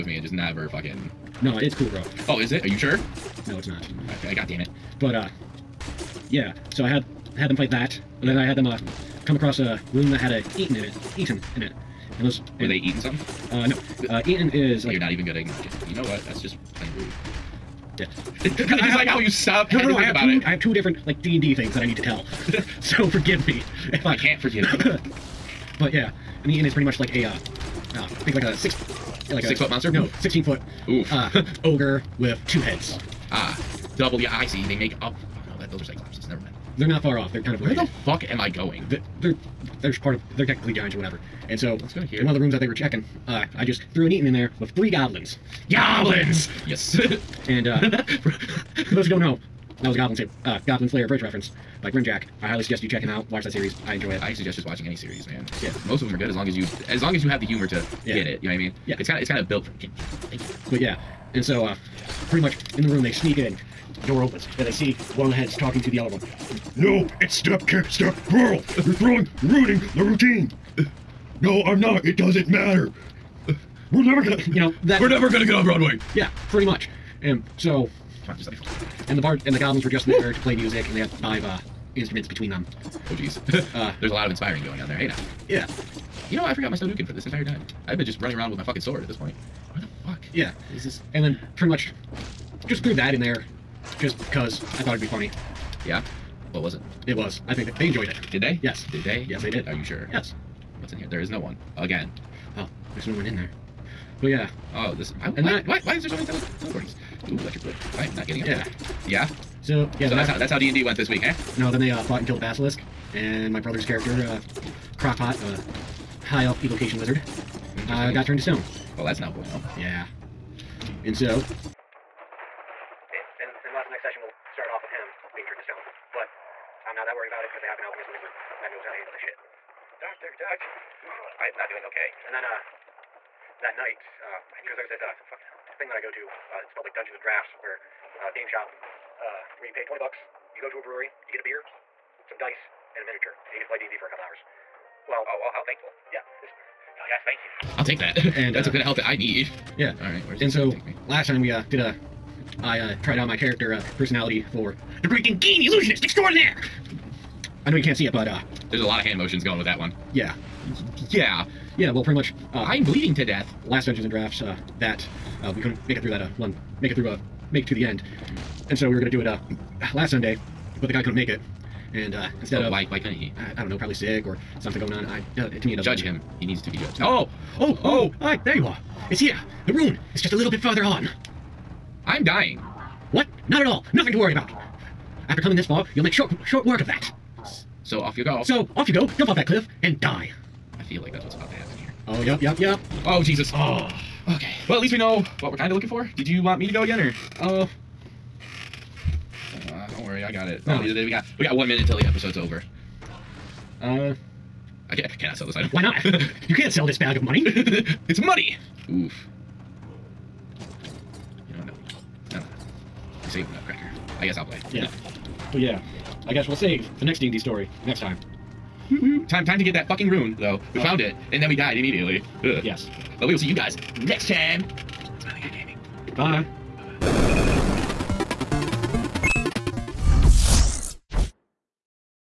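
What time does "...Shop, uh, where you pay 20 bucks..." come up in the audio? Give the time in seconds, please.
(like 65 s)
138 s.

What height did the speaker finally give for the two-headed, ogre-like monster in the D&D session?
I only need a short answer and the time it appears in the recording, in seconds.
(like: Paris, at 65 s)
16 feet, at 30 s.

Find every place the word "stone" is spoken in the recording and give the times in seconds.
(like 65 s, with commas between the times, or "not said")
118 s, 125 s.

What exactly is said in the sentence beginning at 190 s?
I feel like that's what's about to happen here.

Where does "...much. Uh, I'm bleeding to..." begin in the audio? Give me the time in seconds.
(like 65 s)
162 s.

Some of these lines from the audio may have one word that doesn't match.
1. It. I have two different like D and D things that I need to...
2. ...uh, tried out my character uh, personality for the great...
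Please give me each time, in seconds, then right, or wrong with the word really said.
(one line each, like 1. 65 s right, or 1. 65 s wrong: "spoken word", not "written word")
1. 20 s right
2. 152 s right.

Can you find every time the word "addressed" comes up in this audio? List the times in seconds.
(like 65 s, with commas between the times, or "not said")
not said.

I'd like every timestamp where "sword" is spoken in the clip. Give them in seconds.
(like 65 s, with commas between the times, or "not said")
88 s.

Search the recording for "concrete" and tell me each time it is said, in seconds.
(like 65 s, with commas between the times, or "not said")
not said.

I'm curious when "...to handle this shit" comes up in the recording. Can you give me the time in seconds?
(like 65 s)
128 s.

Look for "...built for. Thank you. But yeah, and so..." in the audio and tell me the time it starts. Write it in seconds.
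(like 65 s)
59 s.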